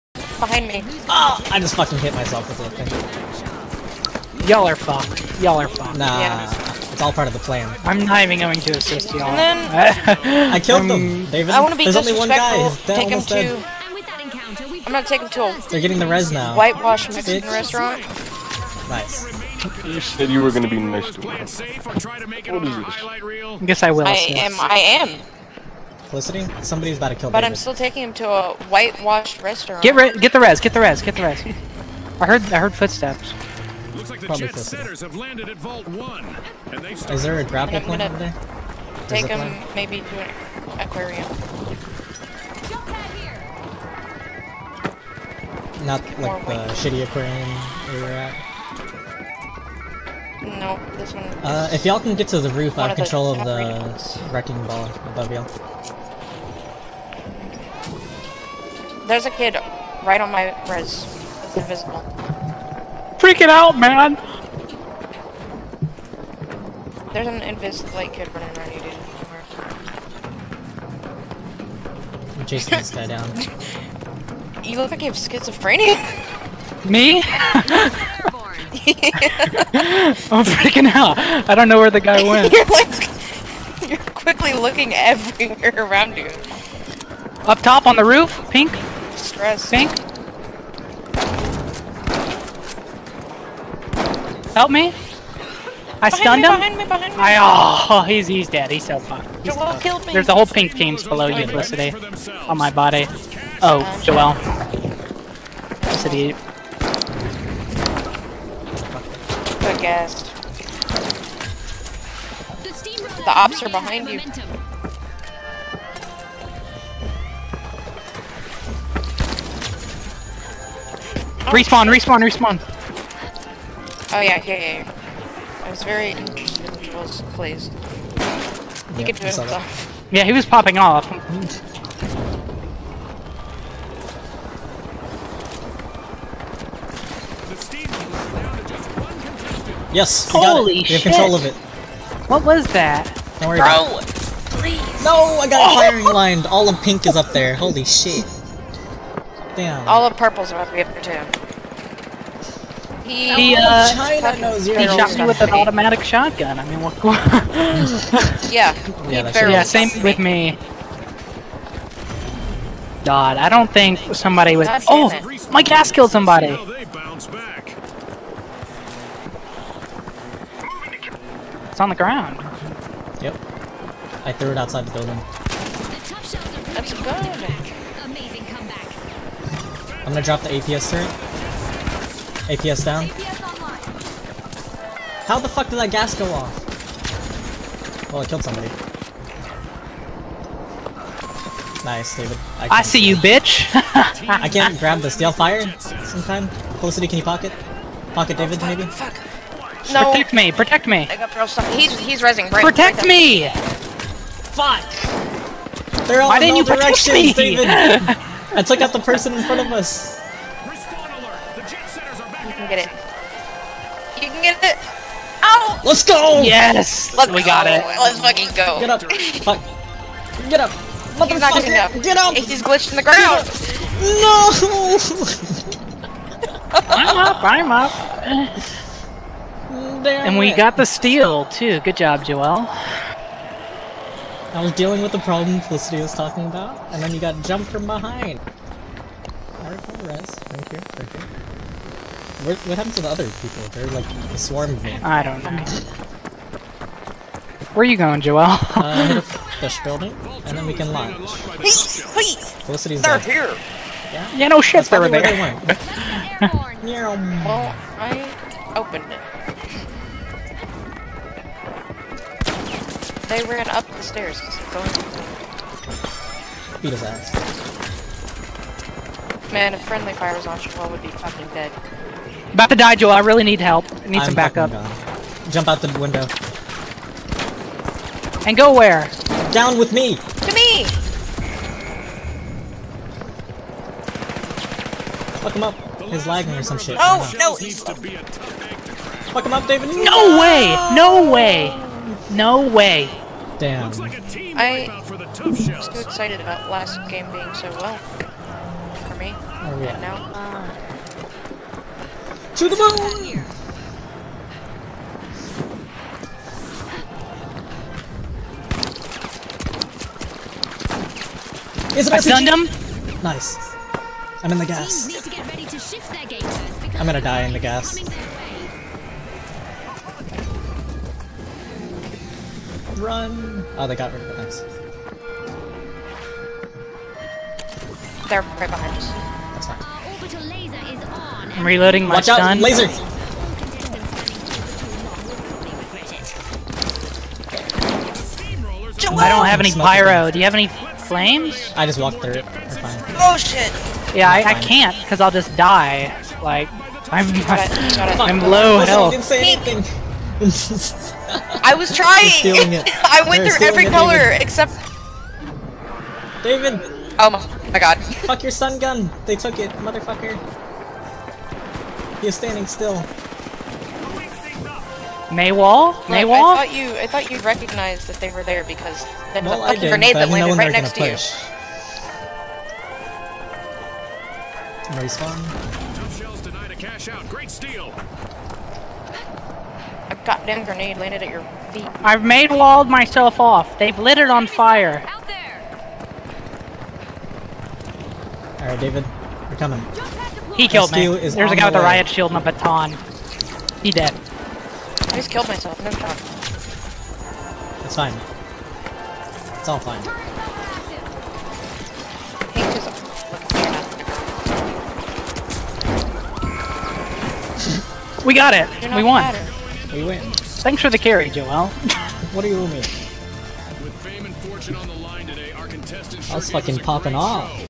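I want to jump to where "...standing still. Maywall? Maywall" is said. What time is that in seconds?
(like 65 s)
362 s.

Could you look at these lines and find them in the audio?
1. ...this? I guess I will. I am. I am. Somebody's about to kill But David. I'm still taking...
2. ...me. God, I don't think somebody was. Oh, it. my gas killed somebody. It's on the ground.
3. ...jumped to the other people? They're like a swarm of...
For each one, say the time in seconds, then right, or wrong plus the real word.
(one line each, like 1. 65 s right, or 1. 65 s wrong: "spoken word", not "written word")
1. 21 s right
2. 160 s right
3. 242 s wrong: "happened", not "jumped".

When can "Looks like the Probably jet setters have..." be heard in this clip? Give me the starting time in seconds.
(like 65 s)
33 s.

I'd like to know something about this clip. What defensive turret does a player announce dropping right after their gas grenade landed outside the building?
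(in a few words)
APS turret.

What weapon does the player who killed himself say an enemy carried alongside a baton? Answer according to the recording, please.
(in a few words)
Riot shield.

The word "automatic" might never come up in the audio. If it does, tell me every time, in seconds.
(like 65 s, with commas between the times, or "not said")
155 s.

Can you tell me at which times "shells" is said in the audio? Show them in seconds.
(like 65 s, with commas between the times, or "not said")
376 s.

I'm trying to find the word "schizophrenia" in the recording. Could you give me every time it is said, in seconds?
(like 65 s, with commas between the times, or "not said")
75 s.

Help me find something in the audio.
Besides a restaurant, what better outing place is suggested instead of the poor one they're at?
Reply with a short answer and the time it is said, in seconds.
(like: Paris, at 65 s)
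An aquarium, at 40 s.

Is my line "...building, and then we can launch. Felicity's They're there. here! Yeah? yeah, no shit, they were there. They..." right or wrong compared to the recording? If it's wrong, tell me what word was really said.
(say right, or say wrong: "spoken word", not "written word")
right.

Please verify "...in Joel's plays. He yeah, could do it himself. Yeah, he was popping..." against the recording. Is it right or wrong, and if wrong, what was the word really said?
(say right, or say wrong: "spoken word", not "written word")
right.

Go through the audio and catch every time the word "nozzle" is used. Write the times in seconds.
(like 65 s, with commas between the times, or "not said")
not said.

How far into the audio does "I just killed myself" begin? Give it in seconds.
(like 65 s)
395 s.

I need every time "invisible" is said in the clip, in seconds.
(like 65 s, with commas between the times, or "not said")
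61 s, 67 s.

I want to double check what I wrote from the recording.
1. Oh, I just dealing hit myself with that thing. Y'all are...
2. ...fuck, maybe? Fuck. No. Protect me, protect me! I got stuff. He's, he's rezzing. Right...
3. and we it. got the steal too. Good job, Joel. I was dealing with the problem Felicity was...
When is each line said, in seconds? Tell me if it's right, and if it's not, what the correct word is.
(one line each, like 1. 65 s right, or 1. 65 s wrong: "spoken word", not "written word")
1. 1 s wrong: "fucking", not "dealing"
2. 198 s right
3. 230 s right.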